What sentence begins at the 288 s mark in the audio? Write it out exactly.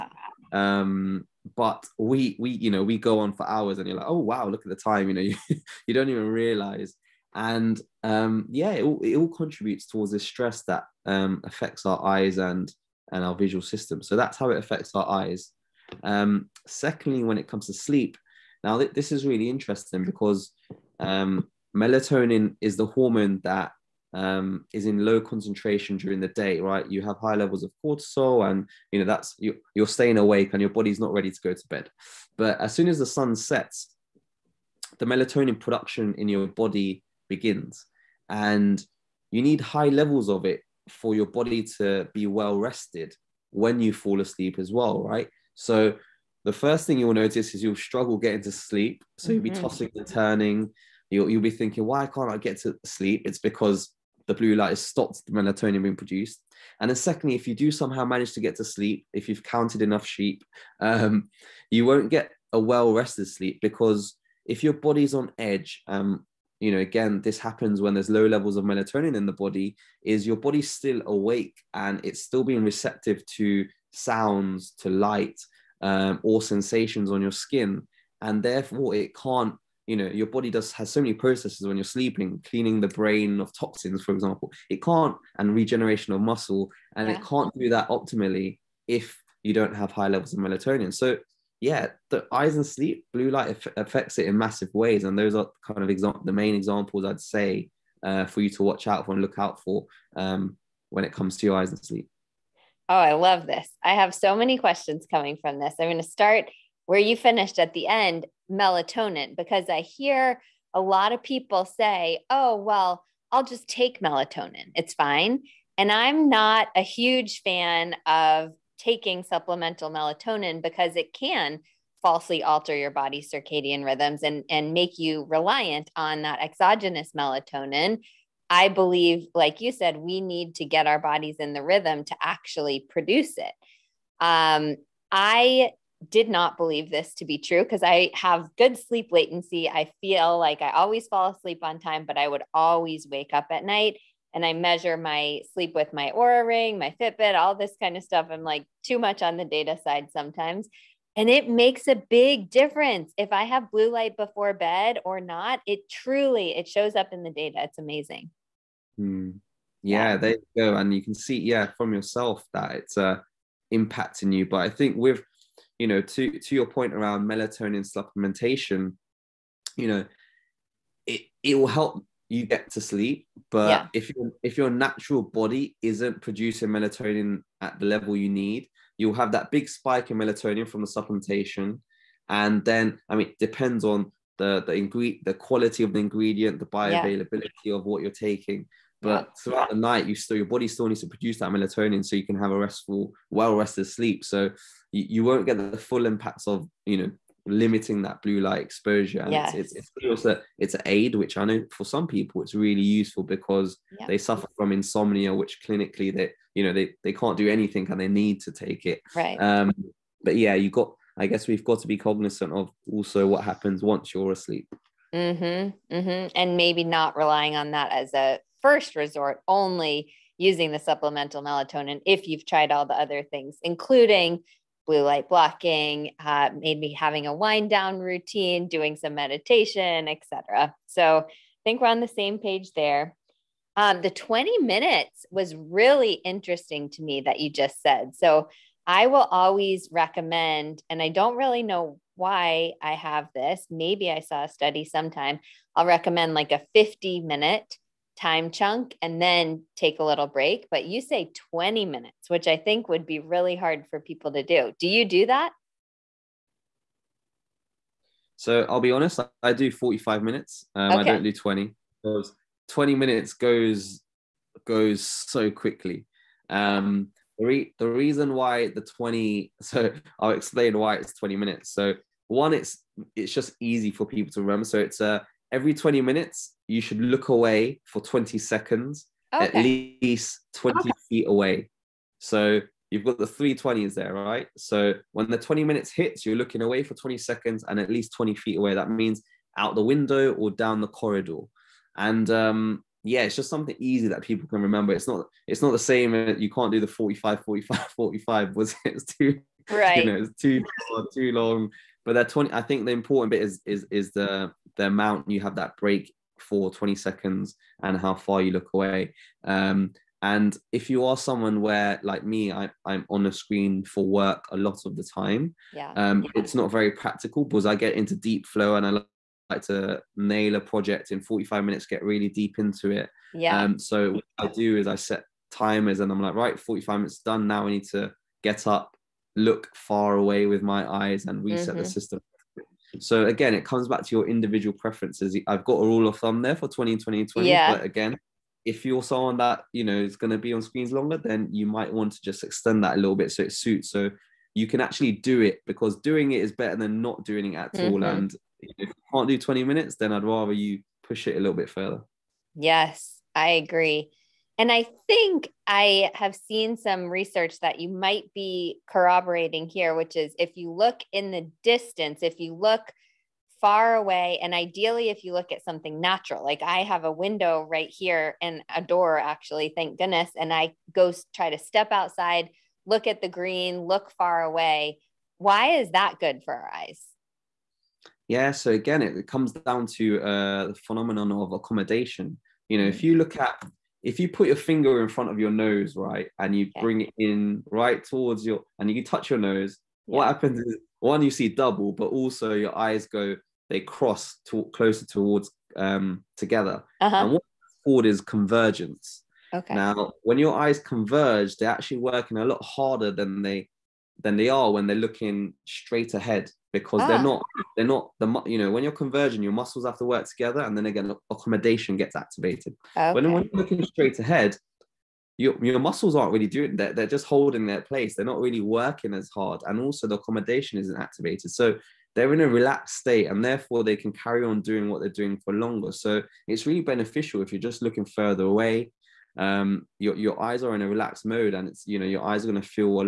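That means out the window or down the corridor.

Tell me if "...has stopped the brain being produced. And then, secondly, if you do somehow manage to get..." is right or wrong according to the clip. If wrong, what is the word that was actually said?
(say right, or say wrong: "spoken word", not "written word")
wrong: "melatonin", not "brain".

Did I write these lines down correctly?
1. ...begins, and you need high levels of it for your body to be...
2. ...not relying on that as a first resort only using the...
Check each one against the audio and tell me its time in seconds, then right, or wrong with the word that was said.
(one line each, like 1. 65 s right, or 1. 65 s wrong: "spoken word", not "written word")
1. 37 s right
2. 216 s right.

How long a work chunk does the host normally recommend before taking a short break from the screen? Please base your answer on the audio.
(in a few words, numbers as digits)
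50 minutes.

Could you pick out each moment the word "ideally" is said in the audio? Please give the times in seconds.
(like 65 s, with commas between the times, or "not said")
364 s.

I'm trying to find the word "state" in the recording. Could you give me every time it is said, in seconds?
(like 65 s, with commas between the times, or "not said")
422 s.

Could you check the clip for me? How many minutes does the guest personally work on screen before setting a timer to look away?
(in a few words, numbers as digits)
45 minutes.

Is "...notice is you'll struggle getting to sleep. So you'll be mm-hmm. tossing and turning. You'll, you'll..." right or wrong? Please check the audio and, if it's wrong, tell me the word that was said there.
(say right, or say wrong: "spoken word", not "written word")
right.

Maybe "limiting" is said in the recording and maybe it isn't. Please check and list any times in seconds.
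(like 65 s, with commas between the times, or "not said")
197 s.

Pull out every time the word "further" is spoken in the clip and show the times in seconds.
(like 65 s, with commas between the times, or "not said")
351 s, 428 s.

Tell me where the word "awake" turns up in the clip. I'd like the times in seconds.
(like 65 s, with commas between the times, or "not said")
30 s, 71 s.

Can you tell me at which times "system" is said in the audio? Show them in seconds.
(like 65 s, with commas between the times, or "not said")
13 s, 331 s.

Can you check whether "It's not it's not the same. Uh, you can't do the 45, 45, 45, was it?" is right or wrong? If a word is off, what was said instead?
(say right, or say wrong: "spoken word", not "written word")
right.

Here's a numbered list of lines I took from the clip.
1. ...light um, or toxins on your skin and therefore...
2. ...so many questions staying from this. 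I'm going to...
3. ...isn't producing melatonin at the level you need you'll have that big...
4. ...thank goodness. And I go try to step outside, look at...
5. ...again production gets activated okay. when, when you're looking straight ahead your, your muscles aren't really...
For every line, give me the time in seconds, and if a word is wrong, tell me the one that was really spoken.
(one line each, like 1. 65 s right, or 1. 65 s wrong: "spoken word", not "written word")
1. 74 s wrong: "sensations", not "toxins"
2. 104 s wrong: "coming", not "staying"
3. 175 s right
4. 369 s right
5. 410 s wrong: "accommodation", not "production".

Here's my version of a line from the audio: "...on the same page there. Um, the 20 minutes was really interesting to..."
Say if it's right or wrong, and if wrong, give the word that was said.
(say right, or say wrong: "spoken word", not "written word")
right.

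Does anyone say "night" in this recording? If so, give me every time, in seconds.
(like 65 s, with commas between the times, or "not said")
143 s, 189 s.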